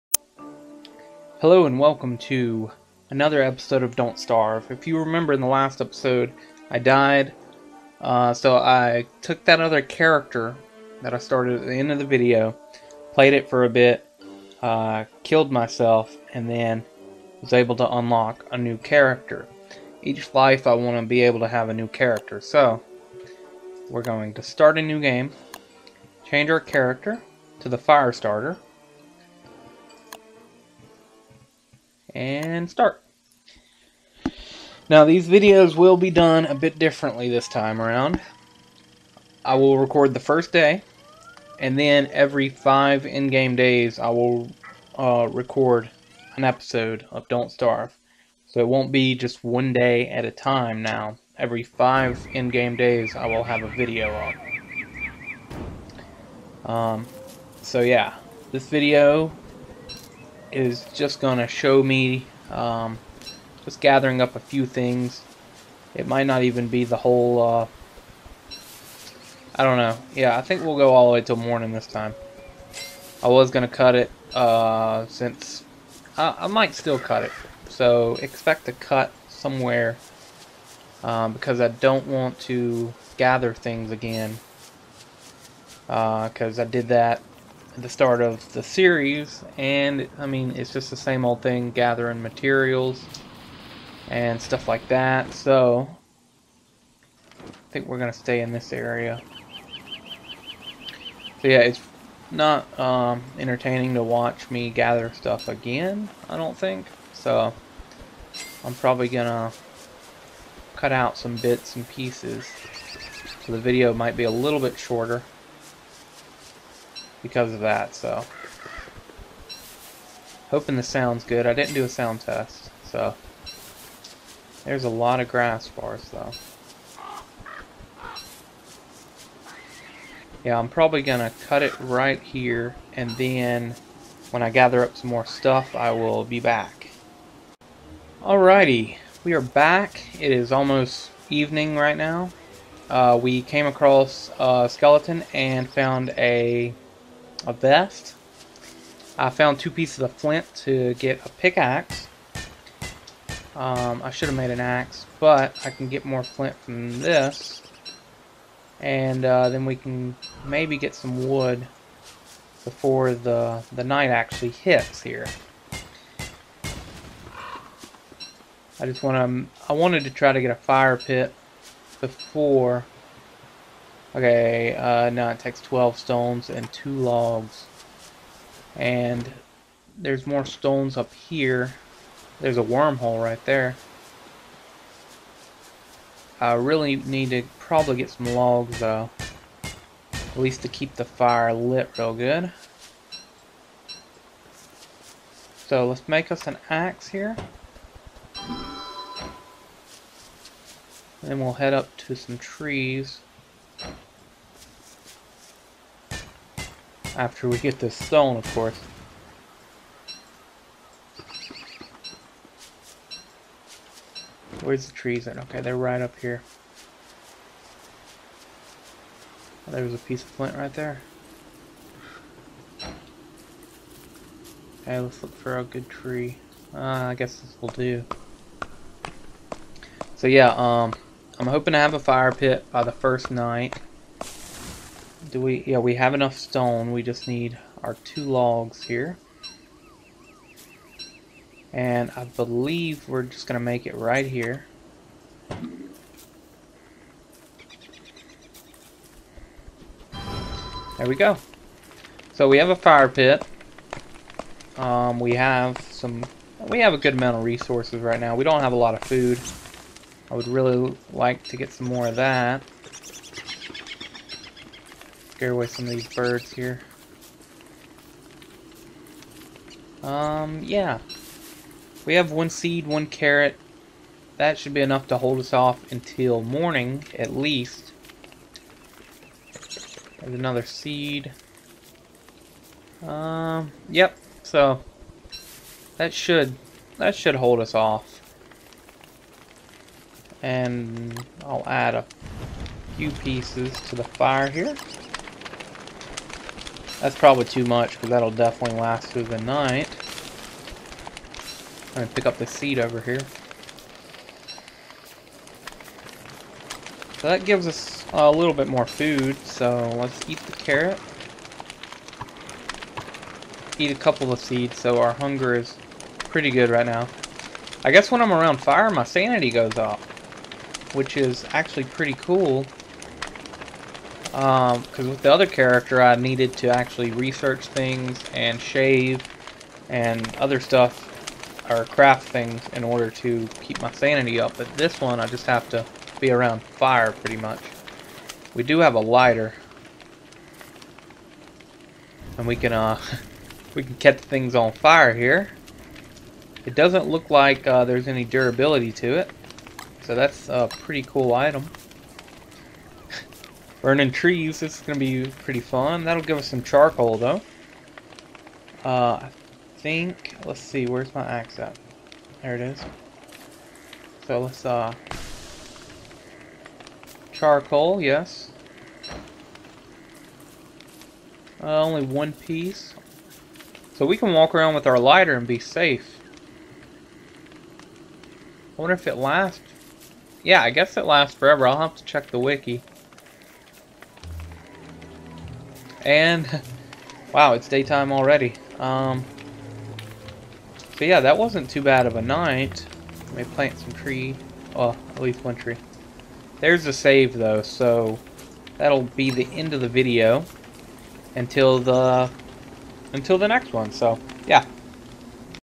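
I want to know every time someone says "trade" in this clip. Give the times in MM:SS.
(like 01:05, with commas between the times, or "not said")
not said.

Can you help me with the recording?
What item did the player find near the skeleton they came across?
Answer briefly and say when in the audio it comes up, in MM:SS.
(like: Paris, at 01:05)
a vest, at 02:27.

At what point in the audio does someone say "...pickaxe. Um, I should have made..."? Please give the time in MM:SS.
02:31.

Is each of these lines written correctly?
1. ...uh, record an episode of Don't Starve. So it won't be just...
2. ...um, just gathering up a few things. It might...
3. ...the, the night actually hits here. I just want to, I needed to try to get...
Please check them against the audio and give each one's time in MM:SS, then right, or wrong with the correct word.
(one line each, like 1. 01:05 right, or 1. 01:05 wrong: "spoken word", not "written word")
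1. 00:44 right
2. 01:02 right
3. 02:43 wrong: "wanted", not "needed".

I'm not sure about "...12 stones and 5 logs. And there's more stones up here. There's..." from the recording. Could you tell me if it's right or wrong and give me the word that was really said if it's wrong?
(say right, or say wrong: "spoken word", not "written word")
wrong: "2", not "5".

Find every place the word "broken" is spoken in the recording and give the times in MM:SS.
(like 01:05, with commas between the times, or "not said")
not said.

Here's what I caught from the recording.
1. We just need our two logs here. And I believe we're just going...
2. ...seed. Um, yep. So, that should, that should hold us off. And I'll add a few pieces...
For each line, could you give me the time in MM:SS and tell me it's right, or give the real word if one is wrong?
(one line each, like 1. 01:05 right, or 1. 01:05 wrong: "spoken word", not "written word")
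1. 03:56 right
2. 04:40 right.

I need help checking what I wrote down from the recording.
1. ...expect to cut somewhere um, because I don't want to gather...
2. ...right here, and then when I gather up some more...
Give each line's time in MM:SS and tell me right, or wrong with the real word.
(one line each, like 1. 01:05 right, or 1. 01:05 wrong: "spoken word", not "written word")
1. 01:18 right
2. 02:11 right.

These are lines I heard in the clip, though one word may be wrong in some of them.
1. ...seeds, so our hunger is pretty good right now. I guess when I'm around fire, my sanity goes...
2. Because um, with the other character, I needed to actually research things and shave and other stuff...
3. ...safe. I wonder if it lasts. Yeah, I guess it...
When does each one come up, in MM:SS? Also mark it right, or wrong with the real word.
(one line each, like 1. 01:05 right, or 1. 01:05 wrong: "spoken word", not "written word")
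1. 05:14 right
2. 05:24 right
3. 06:15 right.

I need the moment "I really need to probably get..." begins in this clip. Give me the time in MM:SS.
03:06.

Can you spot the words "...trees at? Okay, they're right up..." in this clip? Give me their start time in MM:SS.
03:34.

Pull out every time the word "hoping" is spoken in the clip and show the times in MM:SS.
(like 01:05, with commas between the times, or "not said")
02:00, 03:51.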